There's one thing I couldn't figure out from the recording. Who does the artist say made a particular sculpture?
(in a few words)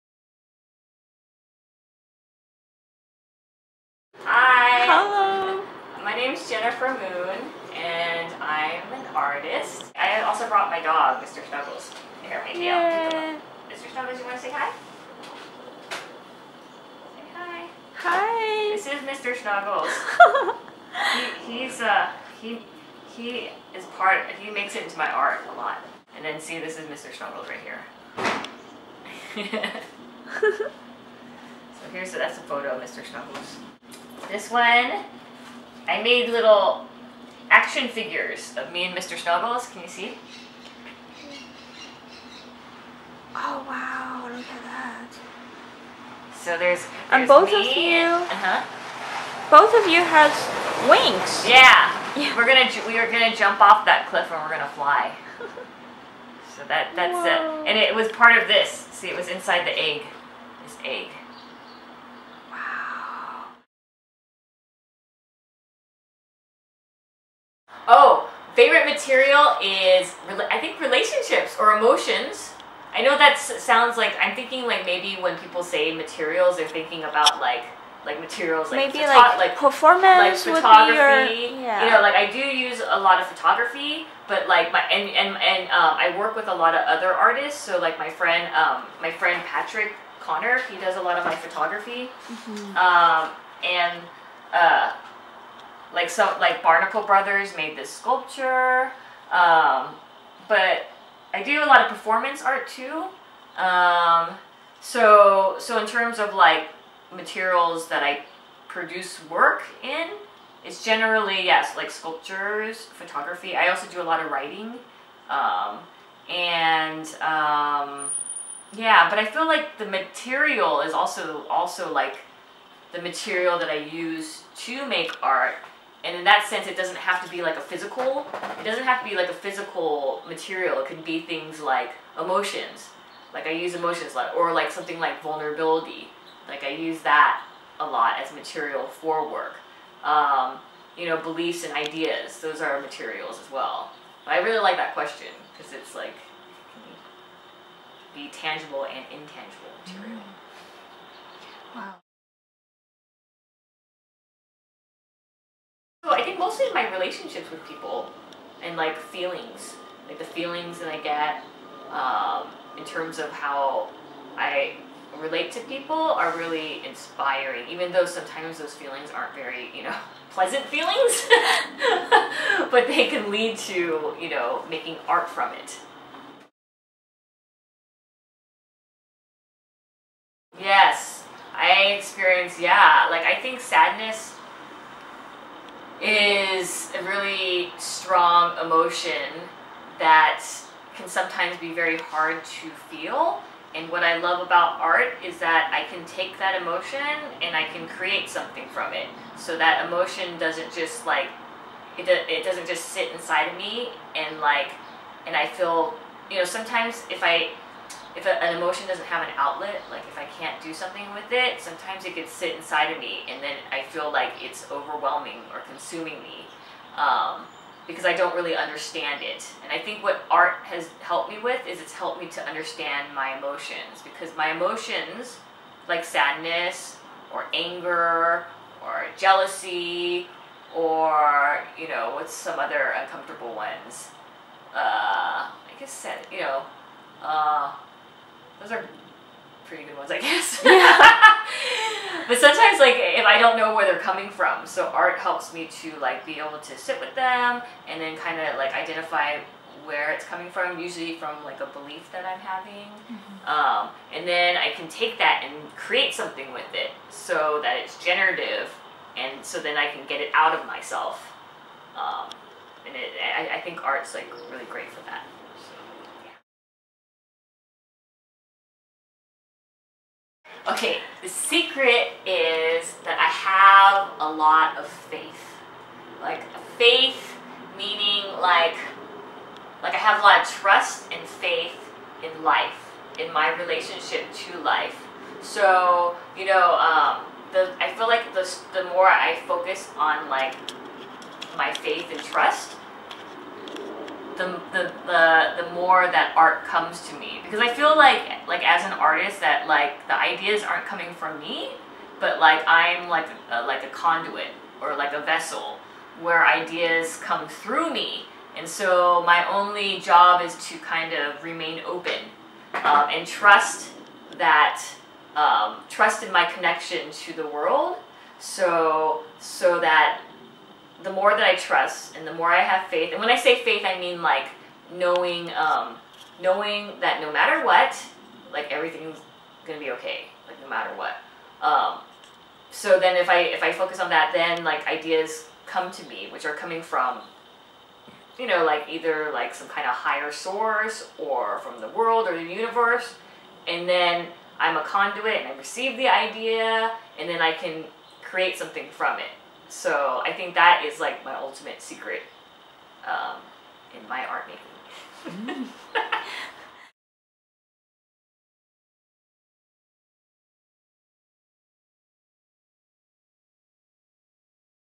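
Barnacle Brothers.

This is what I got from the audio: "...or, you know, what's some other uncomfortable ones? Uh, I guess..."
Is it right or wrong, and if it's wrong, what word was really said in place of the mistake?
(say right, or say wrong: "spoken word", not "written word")
right.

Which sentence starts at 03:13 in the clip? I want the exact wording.
And what I love about art is that I can take that emotion and I can create something from it.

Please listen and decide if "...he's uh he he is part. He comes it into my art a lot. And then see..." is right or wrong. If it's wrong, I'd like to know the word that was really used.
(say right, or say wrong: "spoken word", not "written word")
wrong: "makes", not "comes".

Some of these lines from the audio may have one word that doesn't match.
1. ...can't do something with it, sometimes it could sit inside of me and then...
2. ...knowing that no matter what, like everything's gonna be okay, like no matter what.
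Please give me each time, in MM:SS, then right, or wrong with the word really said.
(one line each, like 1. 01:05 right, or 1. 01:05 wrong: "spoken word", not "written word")
1. 03:30 right
2. 05:26 right.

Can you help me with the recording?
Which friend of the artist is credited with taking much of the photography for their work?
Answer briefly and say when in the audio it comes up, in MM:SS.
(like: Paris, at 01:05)
Patrick Connor, at 01:29.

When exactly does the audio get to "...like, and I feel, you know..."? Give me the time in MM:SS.
03:24.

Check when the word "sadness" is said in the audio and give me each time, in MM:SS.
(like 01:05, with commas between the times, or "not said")
03:03, 03:46.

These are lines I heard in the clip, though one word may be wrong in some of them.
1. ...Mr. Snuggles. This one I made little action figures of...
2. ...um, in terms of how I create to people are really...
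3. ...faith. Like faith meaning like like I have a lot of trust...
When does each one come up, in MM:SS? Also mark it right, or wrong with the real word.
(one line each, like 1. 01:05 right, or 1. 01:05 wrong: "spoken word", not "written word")
1. 00:32 right
2. 02:41 wrong: "relate", not "create"
3. 04:34 right.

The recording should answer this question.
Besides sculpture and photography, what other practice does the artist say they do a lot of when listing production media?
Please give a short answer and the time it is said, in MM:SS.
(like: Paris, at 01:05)
Writing, at 01:54.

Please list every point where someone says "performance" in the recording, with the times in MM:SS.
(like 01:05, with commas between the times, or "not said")
01:19, 01:41.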